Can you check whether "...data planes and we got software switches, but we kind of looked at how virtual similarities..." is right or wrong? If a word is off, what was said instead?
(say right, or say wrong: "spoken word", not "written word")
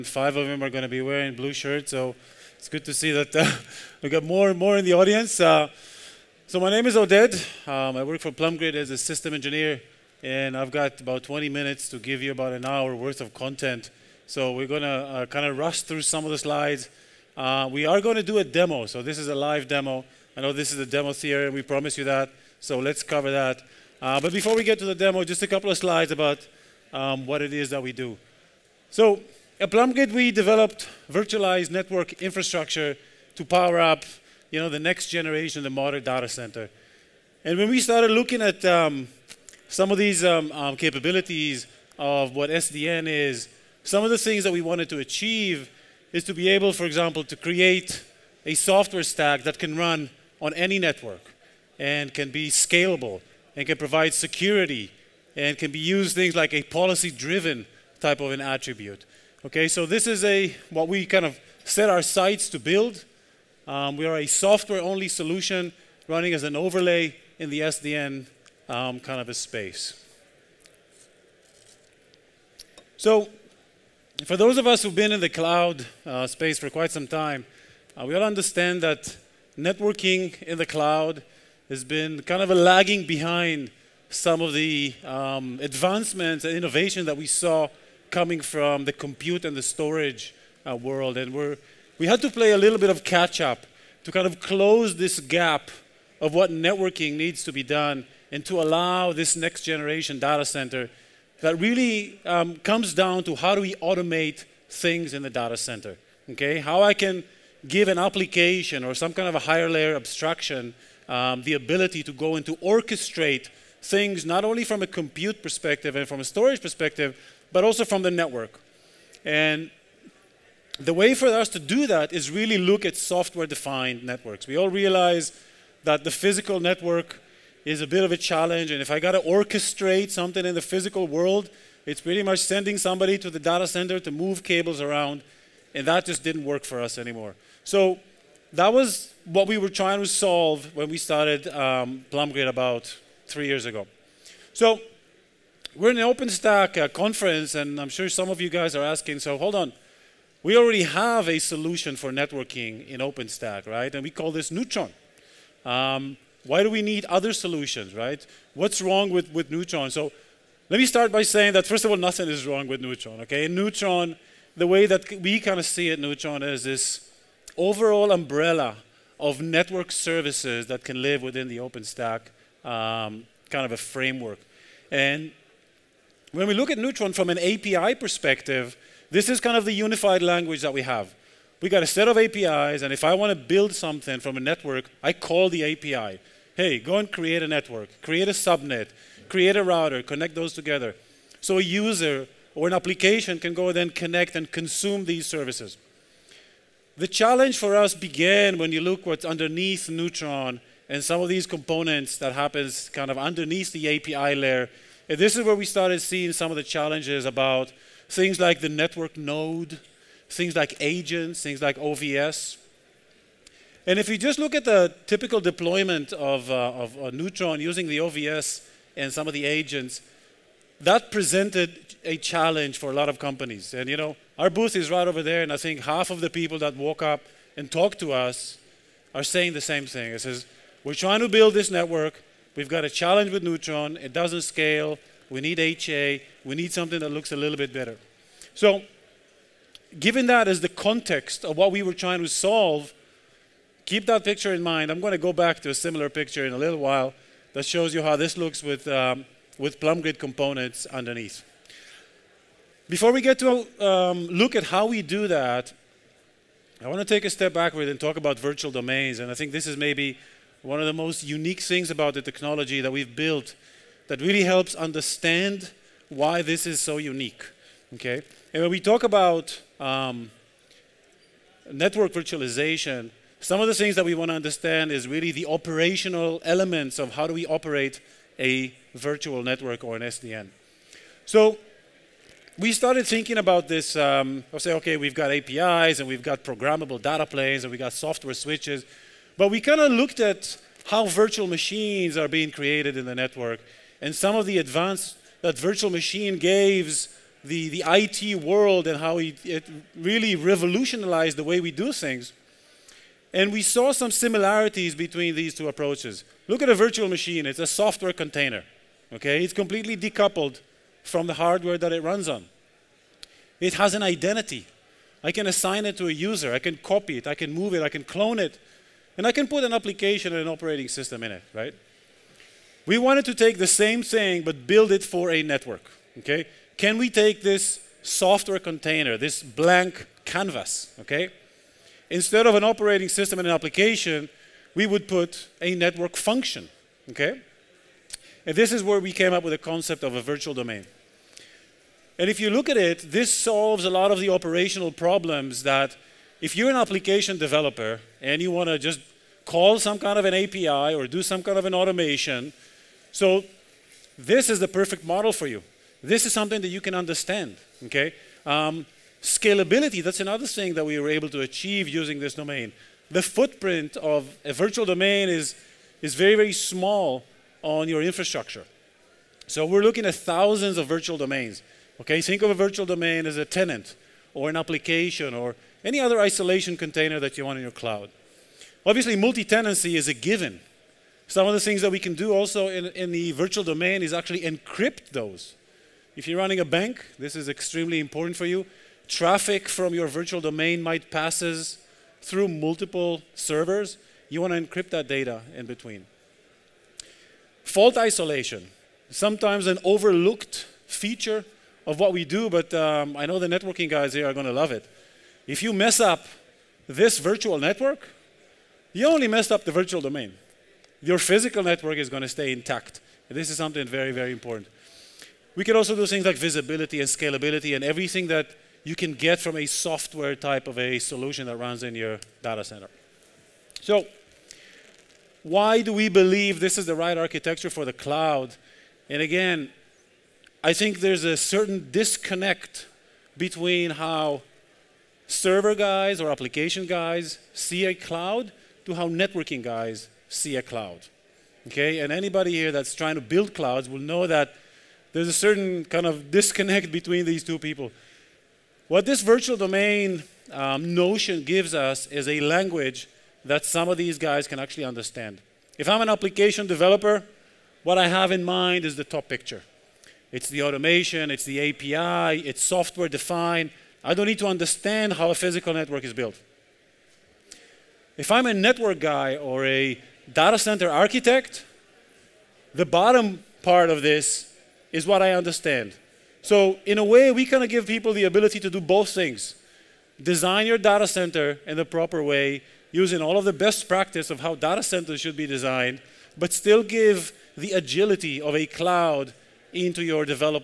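wrong: "machines", not "similarities".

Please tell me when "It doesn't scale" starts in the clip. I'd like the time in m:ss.
3:53.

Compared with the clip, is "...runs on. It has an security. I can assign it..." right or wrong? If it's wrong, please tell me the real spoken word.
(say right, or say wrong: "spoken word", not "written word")
wrong: "identity", not "security".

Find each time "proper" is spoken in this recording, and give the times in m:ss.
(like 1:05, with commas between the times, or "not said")
8:01.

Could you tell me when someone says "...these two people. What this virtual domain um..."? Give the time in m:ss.
7:27.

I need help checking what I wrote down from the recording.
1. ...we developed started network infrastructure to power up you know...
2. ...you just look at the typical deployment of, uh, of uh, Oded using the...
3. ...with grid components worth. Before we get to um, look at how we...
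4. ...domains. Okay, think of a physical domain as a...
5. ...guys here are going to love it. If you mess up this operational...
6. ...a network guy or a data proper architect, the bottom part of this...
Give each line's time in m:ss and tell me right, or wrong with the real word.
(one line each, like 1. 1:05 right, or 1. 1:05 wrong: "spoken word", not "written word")
1. 0:30 wrong: "virtualized", not "started"
2. 3:34 wrong: "Neutron", not "Oded"
3. 4:09 wrong: "underneath", not "worth"
4. 6:11 wrong: "virtual", not "physical"
5. 6:43 wrong: "virtual", not "operational"
6. 7:48 wrong: "center", not "proper".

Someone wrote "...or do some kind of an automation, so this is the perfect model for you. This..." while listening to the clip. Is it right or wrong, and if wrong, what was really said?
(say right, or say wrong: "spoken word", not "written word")
right.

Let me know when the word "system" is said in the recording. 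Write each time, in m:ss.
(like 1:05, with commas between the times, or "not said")
0:08, 5:20, 5:33.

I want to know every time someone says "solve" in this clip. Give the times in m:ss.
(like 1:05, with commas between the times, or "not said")
2:20, 4:02, 5:43.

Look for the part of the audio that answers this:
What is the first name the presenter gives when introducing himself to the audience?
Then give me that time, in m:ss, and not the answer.
0:06.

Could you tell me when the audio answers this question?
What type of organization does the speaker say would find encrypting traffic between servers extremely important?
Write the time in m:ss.
6:26.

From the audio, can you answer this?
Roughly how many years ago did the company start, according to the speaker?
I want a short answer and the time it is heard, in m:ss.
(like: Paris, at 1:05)
3, at 2:23.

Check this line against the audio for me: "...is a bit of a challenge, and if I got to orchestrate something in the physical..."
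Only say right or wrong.
right.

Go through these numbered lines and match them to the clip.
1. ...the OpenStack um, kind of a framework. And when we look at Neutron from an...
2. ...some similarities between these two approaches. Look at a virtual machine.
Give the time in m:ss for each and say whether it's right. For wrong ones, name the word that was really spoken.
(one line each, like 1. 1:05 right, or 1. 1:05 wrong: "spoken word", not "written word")
1. 2:51 right
2. 5:03 right.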